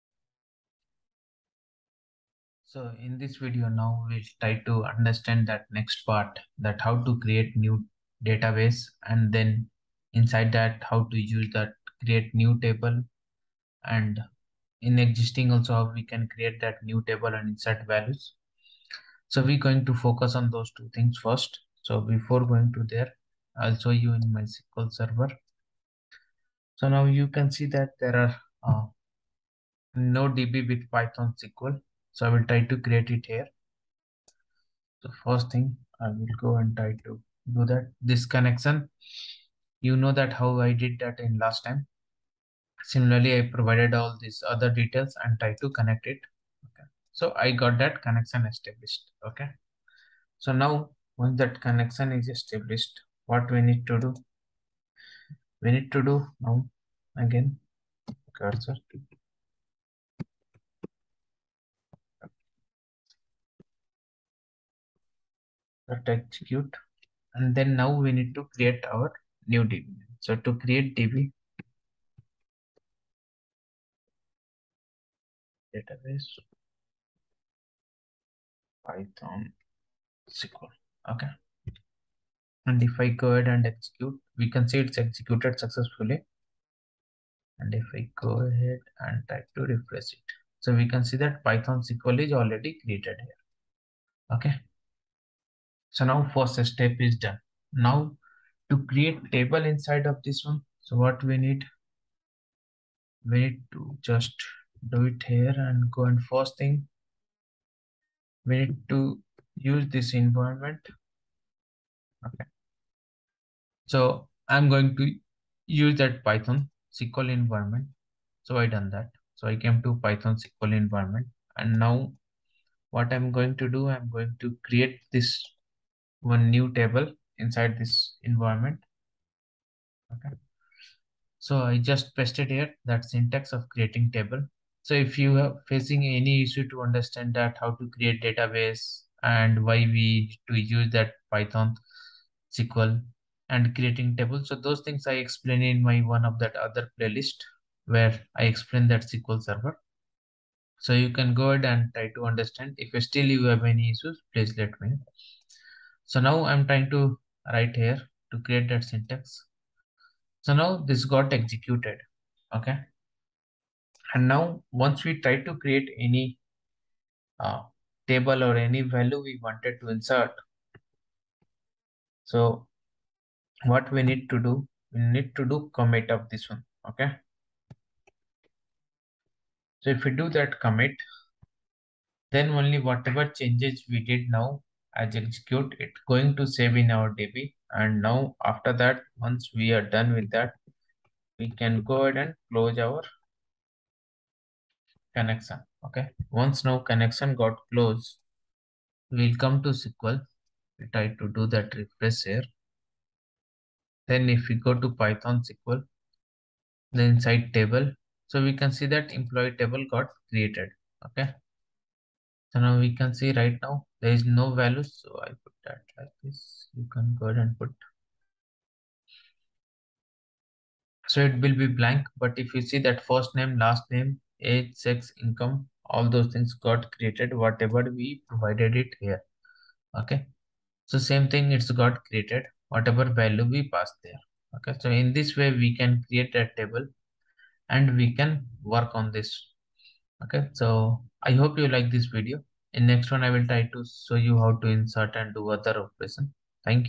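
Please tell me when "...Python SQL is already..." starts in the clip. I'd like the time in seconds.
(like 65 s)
91 s.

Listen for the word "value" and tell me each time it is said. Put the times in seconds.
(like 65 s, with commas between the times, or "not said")
17 s, 168 s, 214 s, 233 s.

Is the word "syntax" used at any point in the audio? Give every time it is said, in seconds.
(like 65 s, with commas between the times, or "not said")
133 s, 158 s.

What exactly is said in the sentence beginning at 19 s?
So we're going to focus on those two things first.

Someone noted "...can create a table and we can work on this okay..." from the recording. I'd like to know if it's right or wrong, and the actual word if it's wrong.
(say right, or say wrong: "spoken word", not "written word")
right.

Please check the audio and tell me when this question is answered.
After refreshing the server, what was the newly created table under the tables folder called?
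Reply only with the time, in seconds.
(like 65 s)
209 s.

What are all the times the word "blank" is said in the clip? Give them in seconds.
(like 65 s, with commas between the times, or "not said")
221 s.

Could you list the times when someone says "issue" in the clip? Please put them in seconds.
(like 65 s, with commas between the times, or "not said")
136 s, 153 s.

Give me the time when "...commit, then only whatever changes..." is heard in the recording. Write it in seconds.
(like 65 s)
180 s.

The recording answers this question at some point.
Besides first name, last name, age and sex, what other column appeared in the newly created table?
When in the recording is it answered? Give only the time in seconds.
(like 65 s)
225 s.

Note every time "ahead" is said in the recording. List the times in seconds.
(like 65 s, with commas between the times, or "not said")
83 s, 88 s, 151 s, 192 s, 217 s.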